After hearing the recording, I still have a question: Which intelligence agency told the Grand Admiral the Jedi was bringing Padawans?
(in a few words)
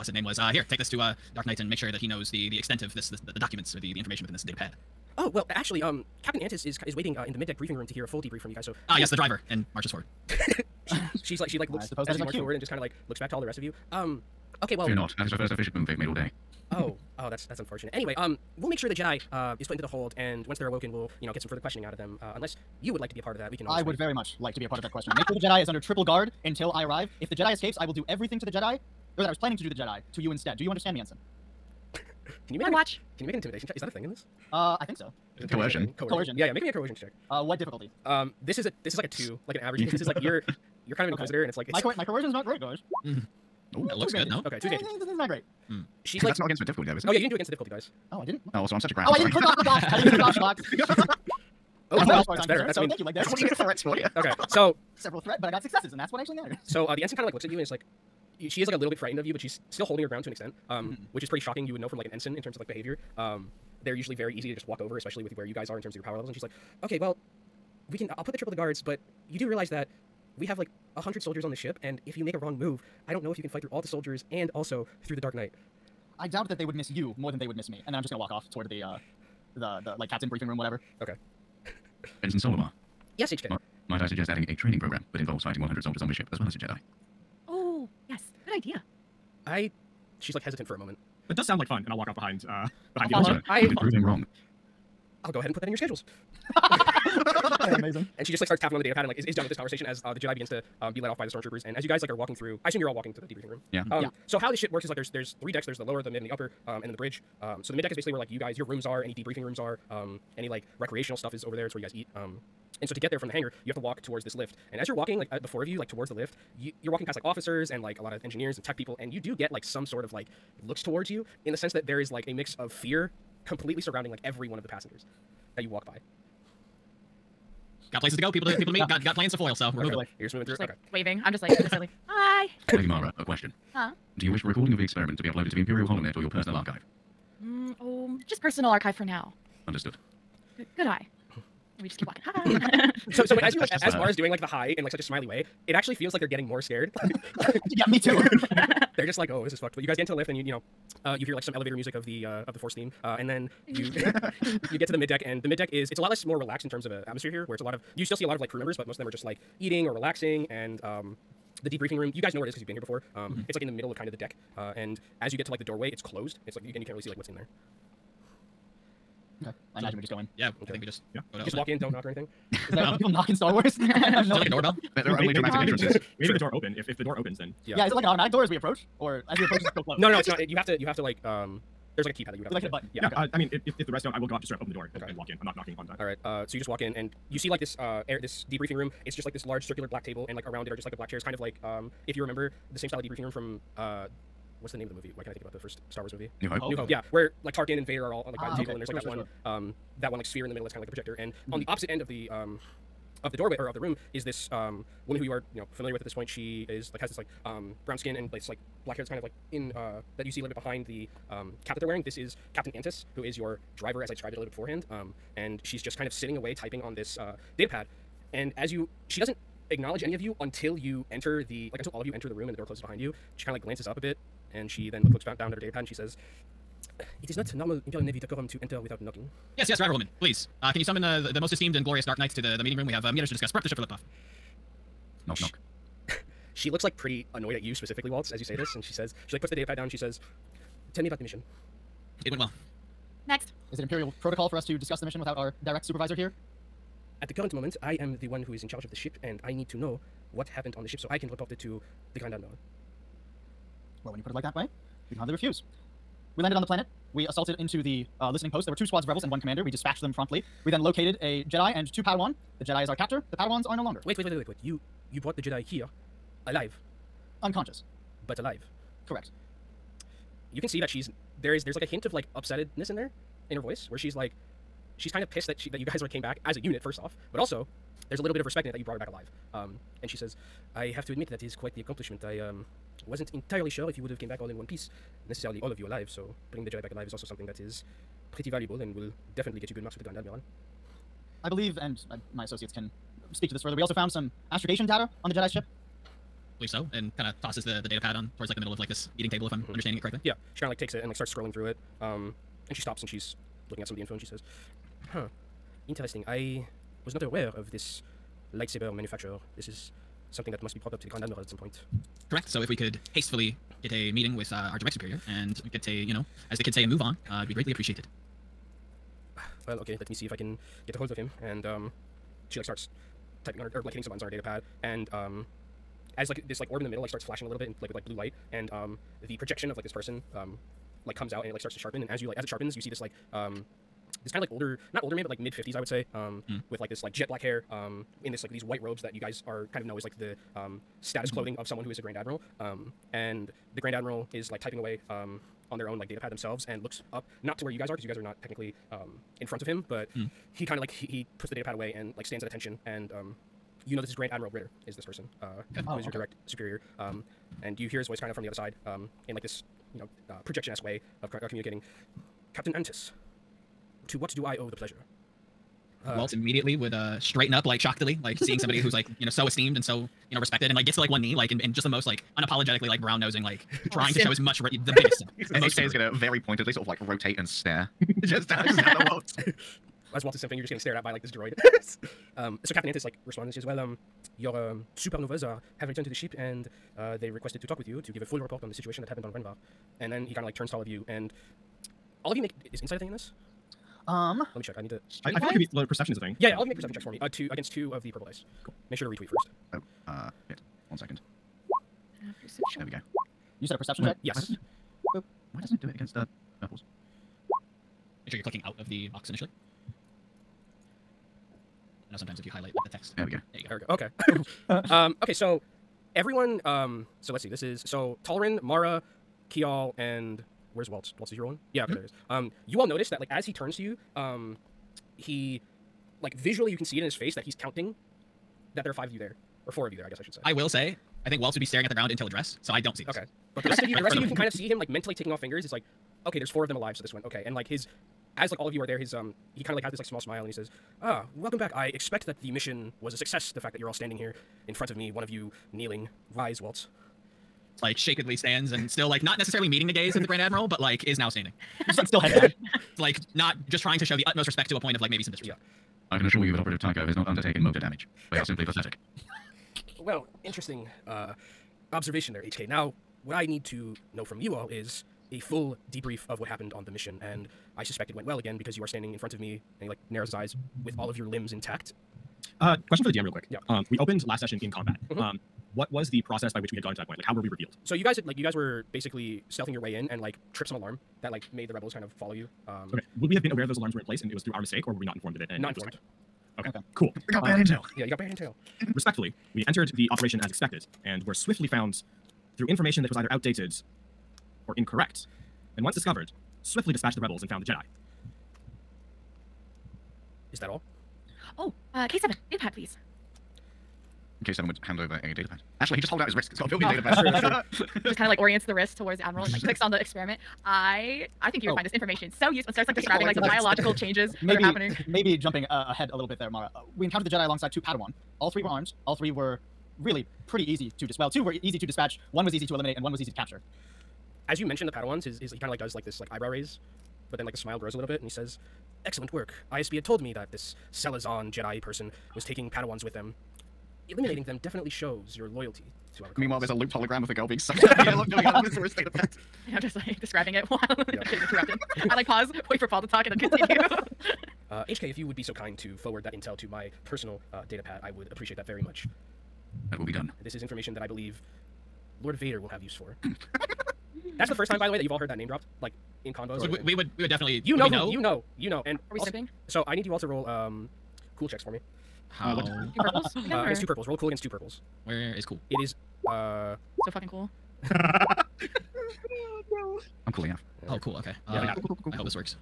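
ISB.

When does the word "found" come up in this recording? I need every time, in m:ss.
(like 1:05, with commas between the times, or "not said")
4:53, 8:11, 8:17.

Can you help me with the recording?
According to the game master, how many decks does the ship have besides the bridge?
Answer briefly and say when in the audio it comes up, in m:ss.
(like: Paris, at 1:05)
3, at 1:45.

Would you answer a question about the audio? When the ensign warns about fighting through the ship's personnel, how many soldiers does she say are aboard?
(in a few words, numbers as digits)
100.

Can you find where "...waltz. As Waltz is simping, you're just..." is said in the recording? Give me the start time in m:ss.
6:19.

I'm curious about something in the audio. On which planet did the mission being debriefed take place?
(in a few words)
Renvar.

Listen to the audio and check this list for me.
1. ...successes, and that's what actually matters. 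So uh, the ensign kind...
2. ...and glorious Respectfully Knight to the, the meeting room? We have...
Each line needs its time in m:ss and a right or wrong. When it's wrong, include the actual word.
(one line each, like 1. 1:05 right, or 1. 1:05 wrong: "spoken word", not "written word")
1. 0:55 right
2. 3:51 wrong: "Dark", not "Respectfully".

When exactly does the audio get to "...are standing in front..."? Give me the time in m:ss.
7:48.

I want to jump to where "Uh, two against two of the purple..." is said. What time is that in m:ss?
6:37.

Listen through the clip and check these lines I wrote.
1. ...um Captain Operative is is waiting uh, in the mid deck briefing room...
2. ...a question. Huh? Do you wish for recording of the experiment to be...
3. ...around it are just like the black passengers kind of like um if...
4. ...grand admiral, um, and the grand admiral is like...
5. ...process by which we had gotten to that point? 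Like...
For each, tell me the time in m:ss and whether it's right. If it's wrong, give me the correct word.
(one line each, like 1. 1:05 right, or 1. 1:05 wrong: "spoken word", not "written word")
1. 0:05 wrong: "Antis", not "Operative"
2. 2:13 right
3. 3:10 wrong: "chairs", not "passengers"
4. 5:42 right
5. 7:56 right.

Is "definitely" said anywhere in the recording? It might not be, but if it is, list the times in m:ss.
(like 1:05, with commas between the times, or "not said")
4:49, 8:54, 9:17.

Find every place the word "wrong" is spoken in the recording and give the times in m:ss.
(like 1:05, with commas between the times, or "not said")
1:12, 1:34.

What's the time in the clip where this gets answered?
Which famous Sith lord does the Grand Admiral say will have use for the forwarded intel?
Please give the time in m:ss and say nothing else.
9:12.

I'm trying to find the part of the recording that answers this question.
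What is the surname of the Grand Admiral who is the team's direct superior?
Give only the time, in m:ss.
5:54.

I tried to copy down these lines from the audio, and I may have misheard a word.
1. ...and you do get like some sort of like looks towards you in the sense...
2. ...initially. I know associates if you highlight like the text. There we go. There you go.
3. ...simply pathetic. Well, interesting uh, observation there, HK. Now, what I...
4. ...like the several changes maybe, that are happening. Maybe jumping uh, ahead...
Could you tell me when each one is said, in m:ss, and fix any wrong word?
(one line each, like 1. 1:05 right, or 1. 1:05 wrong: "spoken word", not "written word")
1. 1:58 right
2. 6:49 wrong: "sometimes", not "associates"
3. 7:38 right
4. 8:33 wrong: "biological", not "several".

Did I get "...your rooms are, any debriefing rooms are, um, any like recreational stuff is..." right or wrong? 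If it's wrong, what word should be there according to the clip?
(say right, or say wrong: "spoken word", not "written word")
right.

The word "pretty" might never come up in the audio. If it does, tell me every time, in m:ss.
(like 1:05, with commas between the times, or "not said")
1:01, 3:56, 4:48, 8:40.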